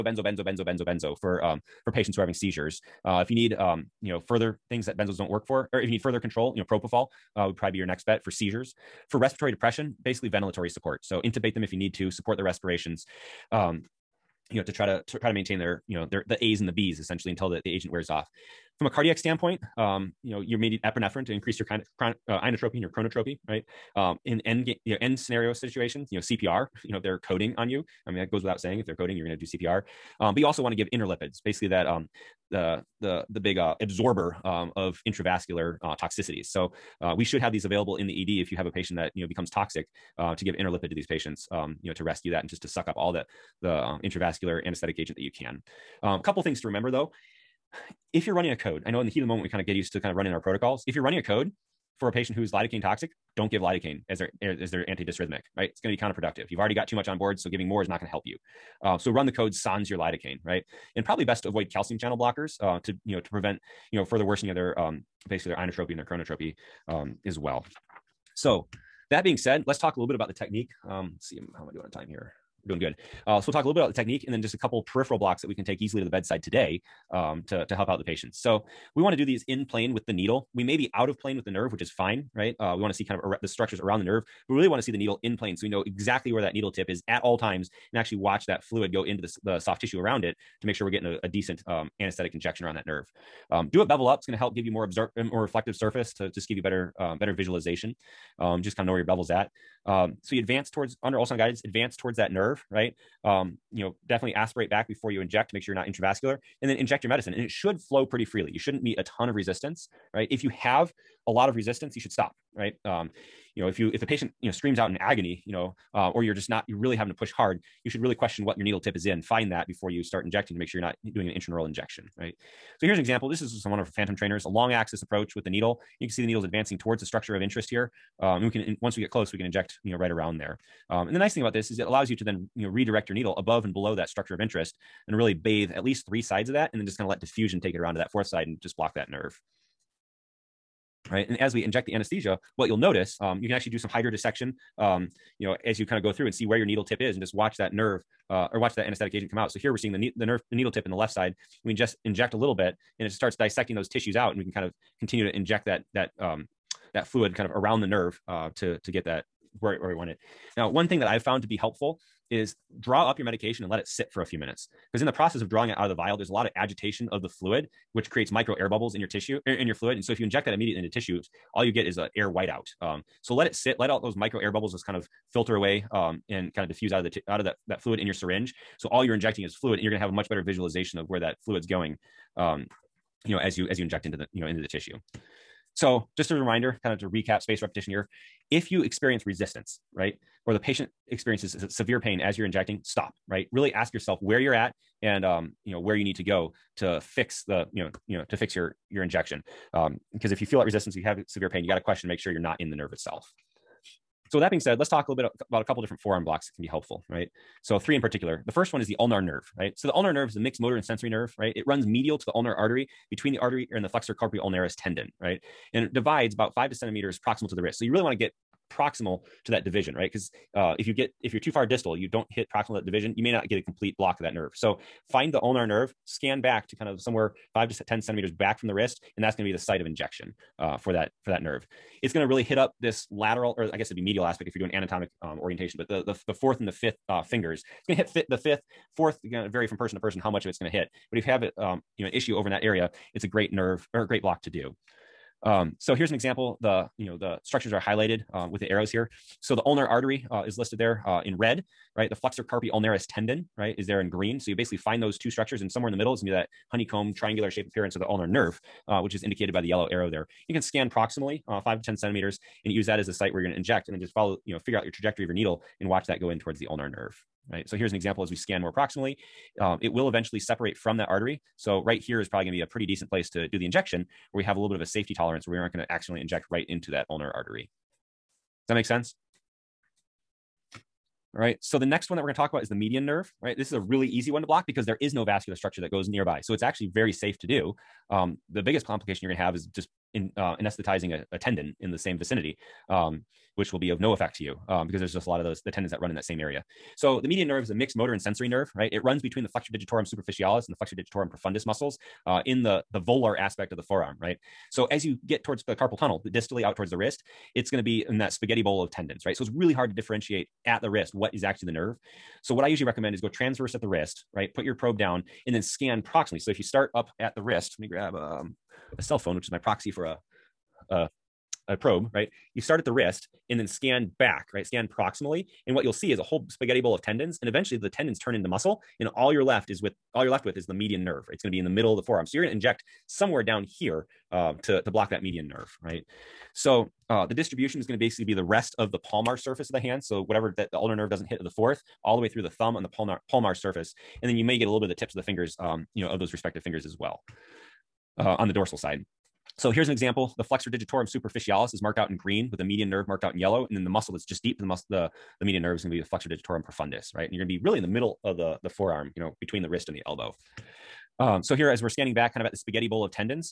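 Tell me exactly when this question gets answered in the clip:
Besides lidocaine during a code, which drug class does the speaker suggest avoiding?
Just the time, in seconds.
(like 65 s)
61 s.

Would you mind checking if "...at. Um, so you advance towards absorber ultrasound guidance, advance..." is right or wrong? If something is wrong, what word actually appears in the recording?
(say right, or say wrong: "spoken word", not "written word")
wrong: "under", not "absorber".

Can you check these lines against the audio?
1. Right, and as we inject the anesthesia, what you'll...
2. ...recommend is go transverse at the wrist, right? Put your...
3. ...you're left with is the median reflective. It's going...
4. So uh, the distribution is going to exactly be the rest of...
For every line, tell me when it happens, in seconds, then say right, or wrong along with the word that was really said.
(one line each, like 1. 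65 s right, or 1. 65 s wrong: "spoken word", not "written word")
1. 141 s right
2. 312 s right
3. 330 s wrong: "nerve", not "reflective"
4. 336 s wrong: "basically", not "exactly".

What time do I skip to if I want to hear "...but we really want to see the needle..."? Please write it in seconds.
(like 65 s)
84 s.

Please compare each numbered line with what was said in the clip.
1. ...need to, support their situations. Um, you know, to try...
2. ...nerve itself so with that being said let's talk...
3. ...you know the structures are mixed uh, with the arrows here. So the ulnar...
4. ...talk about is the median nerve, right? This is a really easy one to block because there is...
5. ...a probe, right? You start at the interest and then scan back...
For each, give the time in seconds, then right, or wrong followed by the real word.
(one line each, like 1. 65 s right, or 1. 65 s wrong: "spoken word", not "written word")
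1. 11 s wrong: "respirations", not "situations"
2. 202 s right
3. 246 s wrong: "highlighted", not "mixed"
4. 282 s right
5. 321 s wrong: "wrist", not "interest".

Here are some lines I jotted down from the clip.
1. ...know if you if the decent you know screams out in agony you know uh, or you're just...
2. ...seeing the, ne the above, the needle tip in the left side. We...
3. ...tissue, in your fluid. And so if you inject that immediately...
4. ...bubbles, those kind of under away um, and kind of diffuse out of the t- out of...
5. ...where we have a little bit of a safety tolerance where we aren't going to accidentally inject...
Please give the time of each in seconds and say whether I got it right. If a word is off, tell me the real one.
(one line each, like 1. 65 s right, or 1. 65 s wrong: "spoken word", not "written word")
1. 113 s wrong: "patient", not "decent"
2. 149 s wrong: "nerve", not "above"
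3. 169 s right
4. 174 s wrong: "filter", not "under"
5. 274 s right.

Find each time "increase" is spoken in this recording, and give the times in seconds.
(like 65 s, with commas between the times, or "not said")
21 s.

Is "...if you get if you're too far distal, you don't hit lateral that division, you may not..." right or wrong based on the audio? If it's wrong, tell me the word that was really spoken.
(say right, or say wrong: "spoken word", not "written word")
wrong: "proximal", not "lateral".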